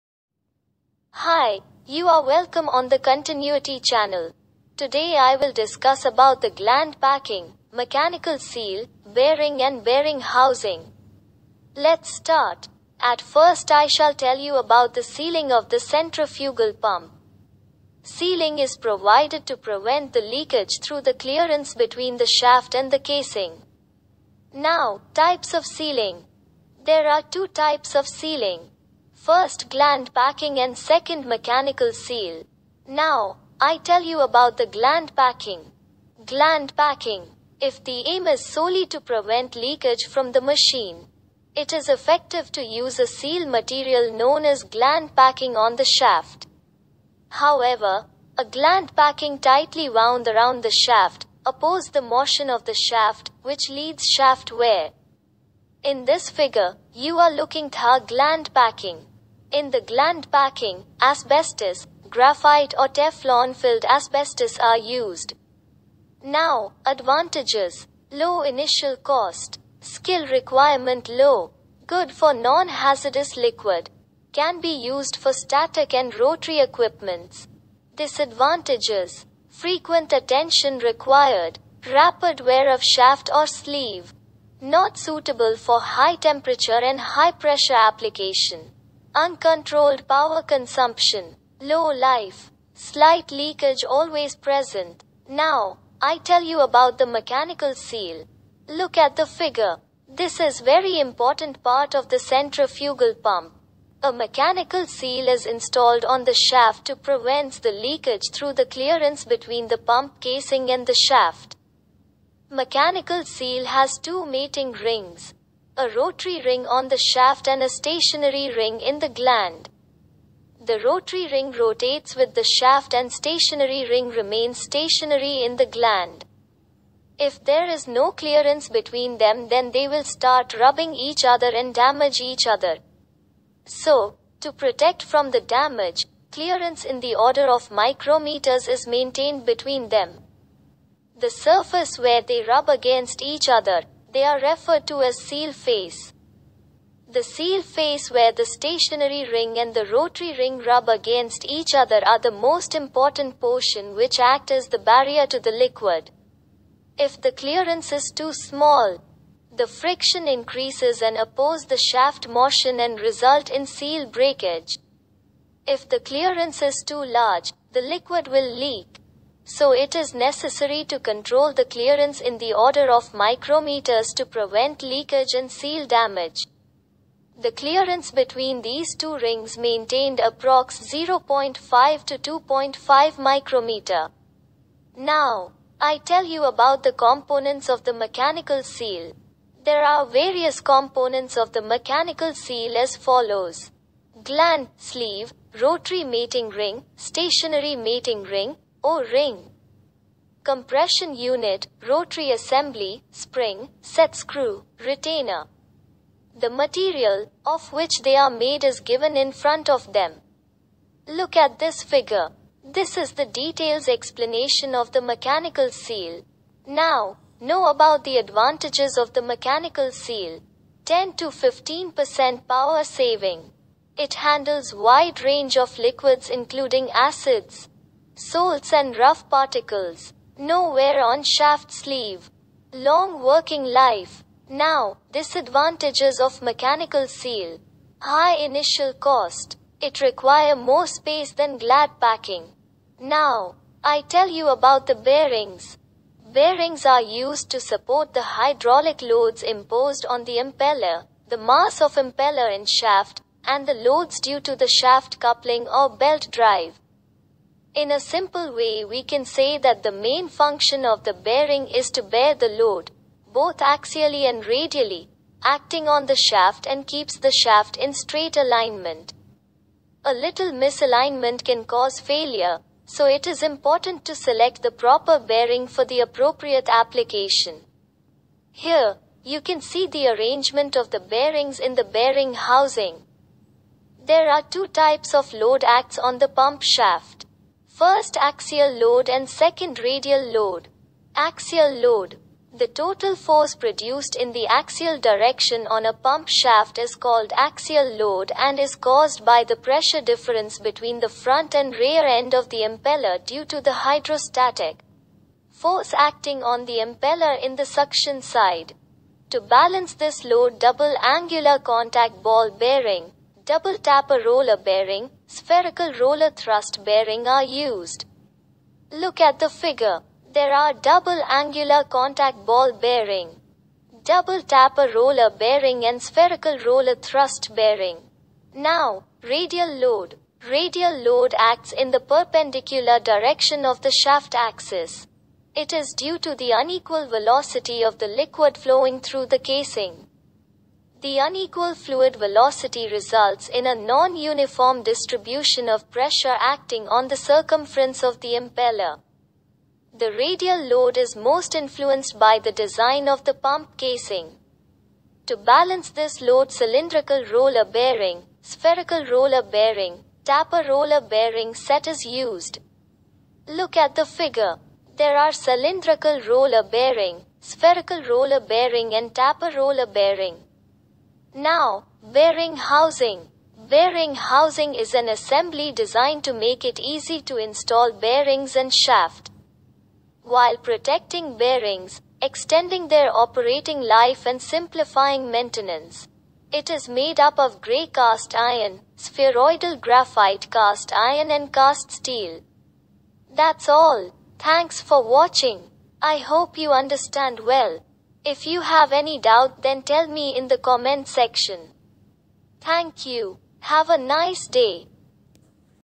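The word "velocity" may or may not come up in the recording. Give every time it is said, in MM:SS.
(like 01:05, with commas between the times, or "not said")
05:37, 05:42.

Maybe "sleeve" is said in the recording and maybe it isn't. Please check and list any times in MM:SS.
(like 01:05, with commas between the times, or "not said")
01:23, 03:14, 03:51.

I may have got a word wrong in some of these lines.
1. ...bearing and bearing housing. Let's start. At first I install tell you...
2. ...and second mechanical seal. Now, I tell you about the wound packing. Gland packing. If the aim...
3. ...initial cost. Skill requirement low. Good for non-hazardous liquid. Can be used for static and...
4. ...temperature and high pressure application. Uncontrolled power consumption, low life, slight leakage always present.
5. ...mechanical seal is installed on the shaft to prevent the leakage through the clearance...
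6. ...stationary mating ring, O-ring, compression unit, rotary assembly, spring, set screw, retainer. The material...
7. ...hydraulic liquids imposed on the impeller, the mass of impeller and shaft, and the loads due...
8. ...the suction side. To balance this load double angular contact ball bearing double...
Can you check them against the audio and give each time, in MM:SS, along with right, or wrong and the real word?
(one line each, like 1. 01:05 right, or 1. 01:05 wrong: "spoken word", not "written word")
1. 00:09 wrong: "shall", not "install"
2. 00:30 wrong: "gland", not "wound"
3. 01:08 right
4. 01:26 right
5. 01:44 right
6. 03:16 right
7. 04:08 wrong: "loads", not "liquids"
8. 05:07 right.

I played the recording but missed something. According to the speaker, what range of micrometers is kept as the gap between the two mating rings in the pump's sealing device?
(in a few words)
0.5 to 2.5 micrometer.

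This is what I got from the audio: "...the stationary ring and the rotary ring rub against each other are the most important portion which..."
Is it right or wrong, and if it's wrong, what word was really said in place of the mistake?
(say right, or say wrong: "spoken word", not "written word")
right.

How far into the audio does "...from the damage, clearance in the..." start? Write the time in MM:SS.
02:15.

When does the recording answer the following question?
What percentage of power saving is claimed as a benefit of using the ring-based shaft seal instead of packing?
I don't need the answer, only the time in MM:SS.
03:40.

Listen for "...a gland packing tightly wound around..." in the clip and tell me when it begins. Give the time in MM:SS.
00:48.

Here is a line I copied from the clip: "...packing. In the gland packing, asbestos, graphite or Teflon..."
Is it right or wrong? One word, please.
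right.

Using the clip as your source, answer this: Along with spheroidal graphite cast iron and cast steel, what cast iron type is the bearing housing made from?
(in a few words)
Gray cast iron.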